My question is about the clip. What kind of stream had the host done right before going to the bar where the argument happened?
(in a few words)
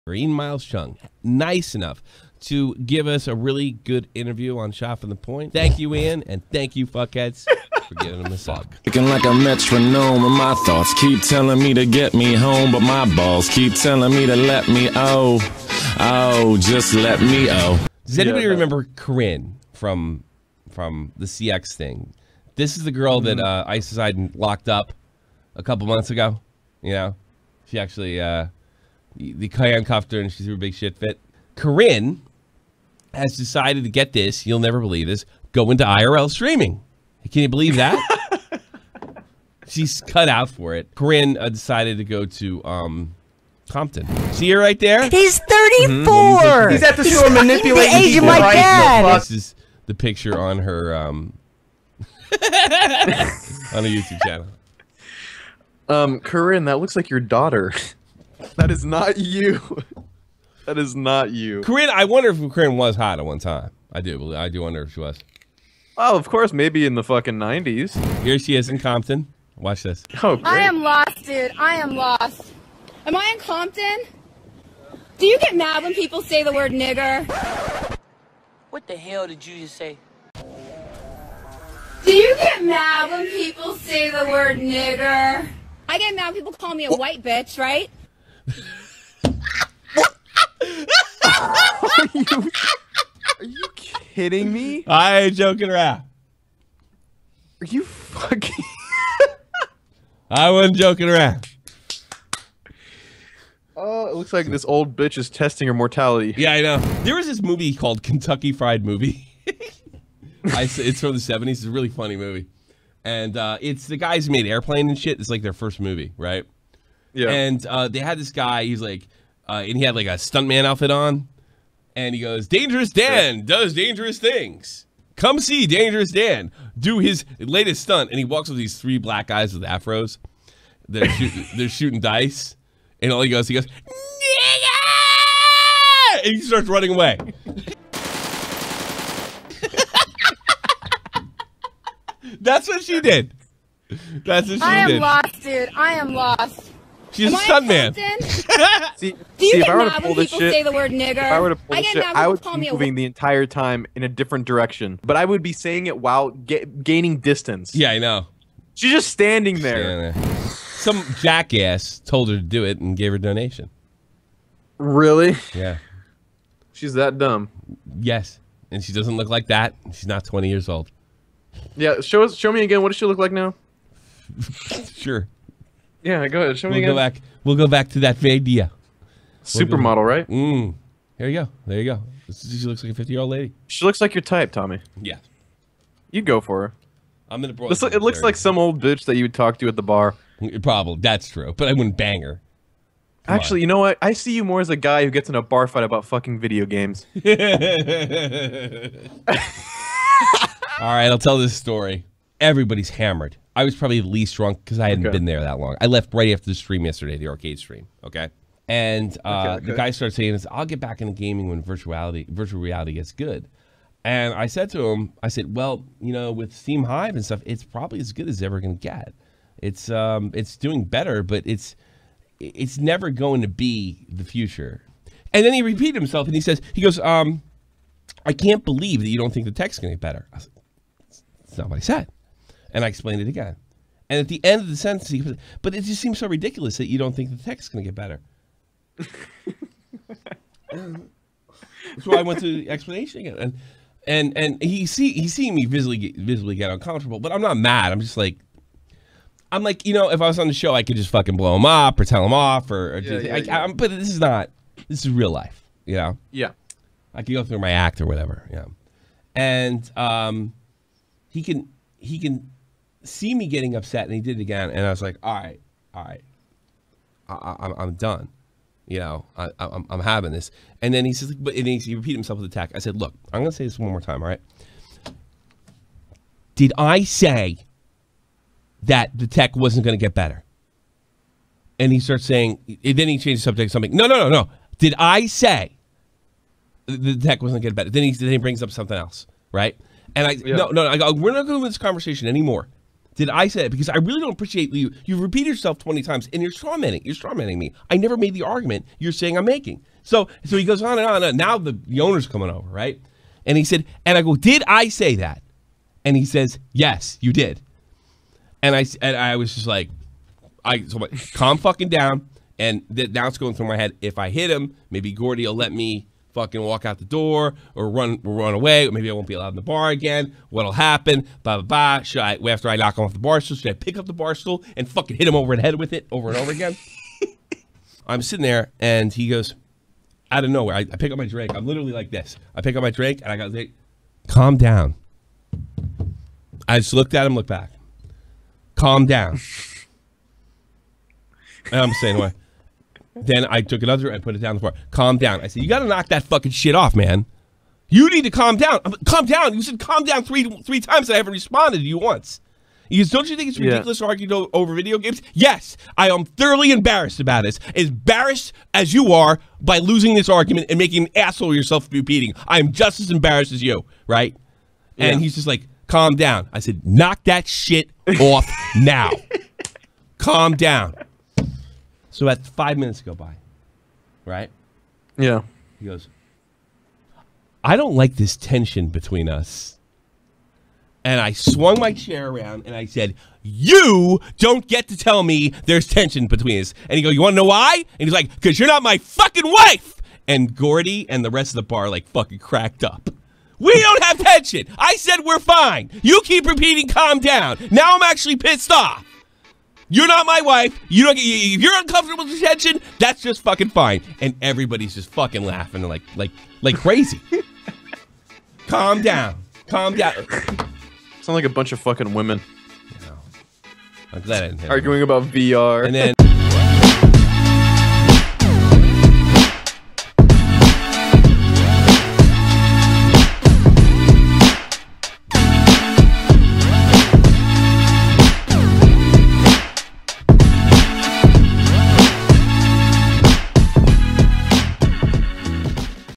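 arcade stream.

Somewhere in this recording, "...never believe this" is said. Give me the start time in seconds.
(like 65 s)
34 s.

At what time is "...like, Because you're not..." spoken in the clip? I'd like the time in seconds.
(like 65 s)
388 s.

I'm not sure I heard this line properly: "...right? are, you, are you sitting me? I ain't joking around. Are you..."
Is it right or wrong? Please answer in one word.
wrong.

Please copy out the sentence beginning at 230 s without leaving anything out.
Like, it's not what I said.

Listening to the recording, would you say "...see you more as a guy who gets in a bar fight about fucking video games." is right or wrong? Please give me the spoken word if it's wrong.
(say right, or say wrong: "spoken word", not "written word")
right.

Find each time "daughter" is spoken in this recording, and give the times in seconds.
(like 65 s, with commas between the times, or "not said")
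57 s.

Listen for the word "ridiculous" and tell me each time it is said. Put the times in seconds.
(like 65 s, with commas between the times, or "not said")
236 s, 353 s.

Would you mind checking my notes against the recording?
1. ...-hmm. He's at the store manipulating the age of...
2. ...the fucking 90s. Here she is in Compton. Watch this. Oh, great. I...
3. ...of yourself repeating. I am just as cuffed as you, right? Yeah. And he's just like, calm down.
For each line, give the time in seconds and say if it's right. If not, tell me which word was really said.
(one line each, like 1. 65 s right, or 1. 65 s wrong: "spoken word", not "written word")
1. 46 s right
2. 66 s right
3. 361 s wrong: "embarrassed", not "cuffed".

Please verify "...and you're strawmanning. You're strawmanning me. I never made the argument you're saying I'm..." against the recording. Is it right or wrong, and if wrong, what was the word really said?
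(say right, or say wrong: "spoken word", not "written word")
right.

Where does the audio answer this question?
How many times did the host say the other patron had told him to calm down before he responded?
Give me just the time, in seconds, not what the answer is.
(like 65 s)
350 s.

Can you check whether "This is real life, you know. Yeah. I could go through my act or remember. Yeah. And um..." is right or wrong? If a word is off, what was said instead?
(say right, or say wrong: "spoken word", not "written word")
wrong: "whatever", not "remember".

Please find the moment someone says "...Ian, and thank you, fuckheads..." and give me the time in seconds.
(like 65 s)
5 s.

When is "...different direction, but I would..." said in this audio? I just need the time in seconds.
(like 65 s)
154 s.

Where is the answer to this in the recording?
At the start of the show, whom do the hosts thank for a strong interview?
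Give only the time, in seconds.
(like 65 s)
0 s.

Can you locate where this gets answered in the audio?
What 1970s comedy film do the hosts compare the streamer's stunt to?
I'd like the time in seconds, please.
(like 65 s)
108 s.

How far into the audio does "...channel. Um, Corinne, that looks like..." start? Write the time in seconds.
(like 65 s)
54 s.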